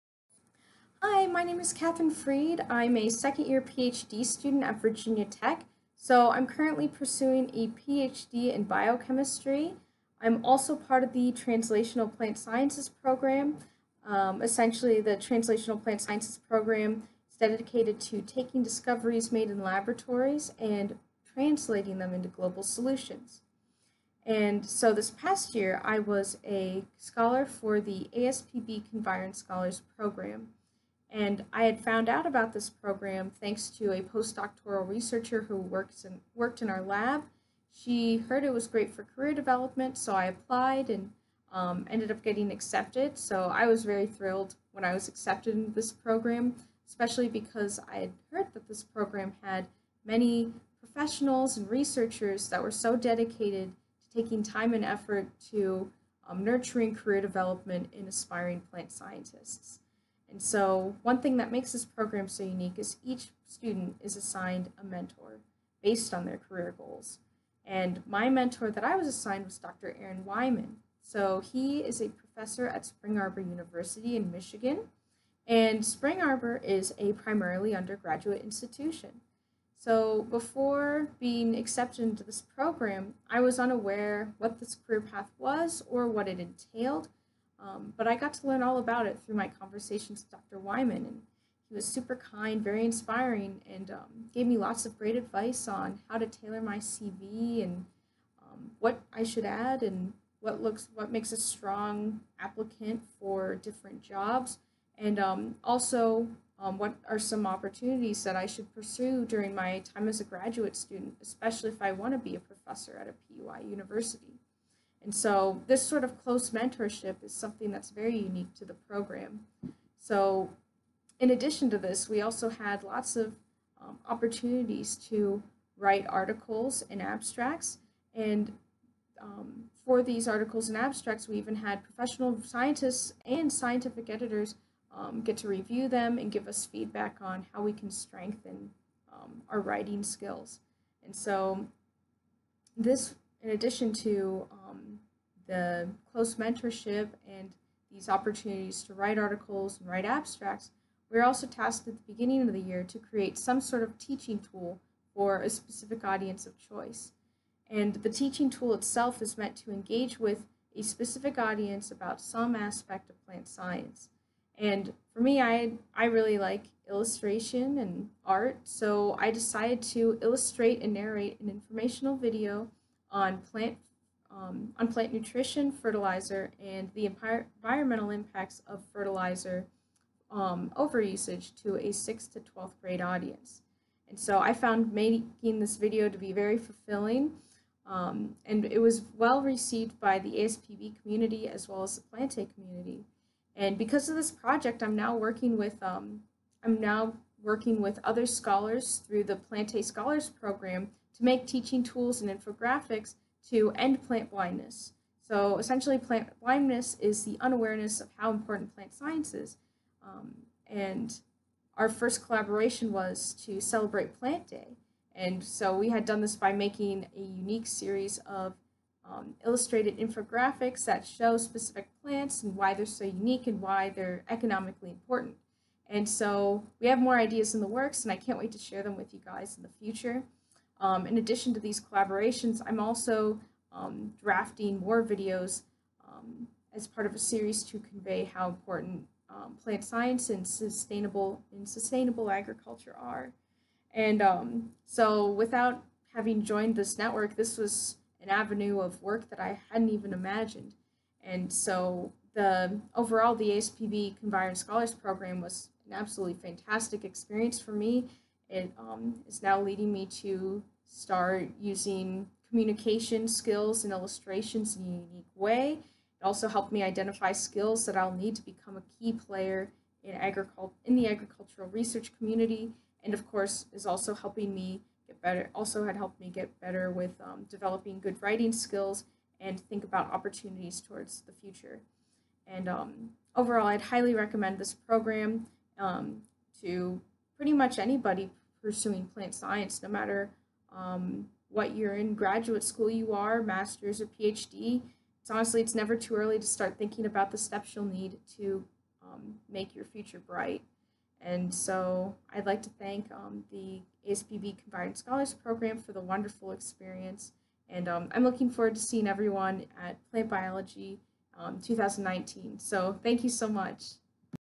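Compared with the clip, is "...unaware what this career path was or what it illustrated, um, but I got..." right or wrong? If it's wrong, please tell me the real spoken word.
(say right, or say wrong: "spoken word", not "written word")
wrong: "entailed", not "illustrated".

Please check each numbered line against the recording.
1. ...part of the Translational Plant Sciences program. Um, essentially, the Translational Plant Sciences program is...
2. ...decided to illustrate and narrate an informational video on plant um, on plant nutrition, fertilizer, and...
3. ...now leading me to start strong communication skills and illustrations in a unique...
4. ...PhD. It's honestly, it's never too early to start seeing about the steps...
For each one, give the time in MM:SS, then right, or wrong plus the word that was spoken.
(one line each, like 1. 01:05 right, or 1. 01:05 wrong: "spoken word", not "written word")
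1. 00:10 right
2. 02:49 right
3. 04:19 wrong: "using", not "strong"
4. 04:54 wrong: "thinking", not "seeing".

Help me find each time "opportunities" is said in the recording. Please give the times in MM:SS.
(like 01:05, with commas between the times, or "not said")
01:47, 02:04, 02:28, 04:40.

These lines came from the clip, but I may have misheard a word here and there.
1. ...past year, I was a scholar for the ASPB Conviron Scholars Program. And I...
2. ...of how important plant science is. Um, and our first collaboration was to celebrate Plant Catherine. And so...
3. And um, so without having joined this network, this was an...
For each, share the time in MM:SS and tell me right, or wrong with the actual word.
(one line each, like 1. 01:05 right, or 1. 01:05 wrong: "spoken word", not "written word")
1. 00:25 right
2. 03:28 wrong: "Day", not "Catherine"
3. 04:03 right.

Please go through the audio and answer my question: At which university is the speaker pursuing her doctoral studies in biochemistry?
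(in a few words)
Virginia Tech.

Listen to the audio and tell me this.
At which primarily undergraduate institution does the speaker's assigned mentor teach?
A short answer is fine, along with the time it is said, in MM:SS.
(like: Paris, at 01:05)
Spring Arbor University, at 01:12.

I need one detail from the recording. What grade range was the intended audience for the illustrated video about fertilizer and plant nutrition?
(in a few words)
6th to 12th grade.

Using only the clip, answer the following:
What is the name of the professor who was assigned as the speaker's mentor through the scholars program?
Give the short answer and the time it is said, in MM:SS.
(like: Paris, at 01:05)
Dr. Aaron Wyman, at 01:09.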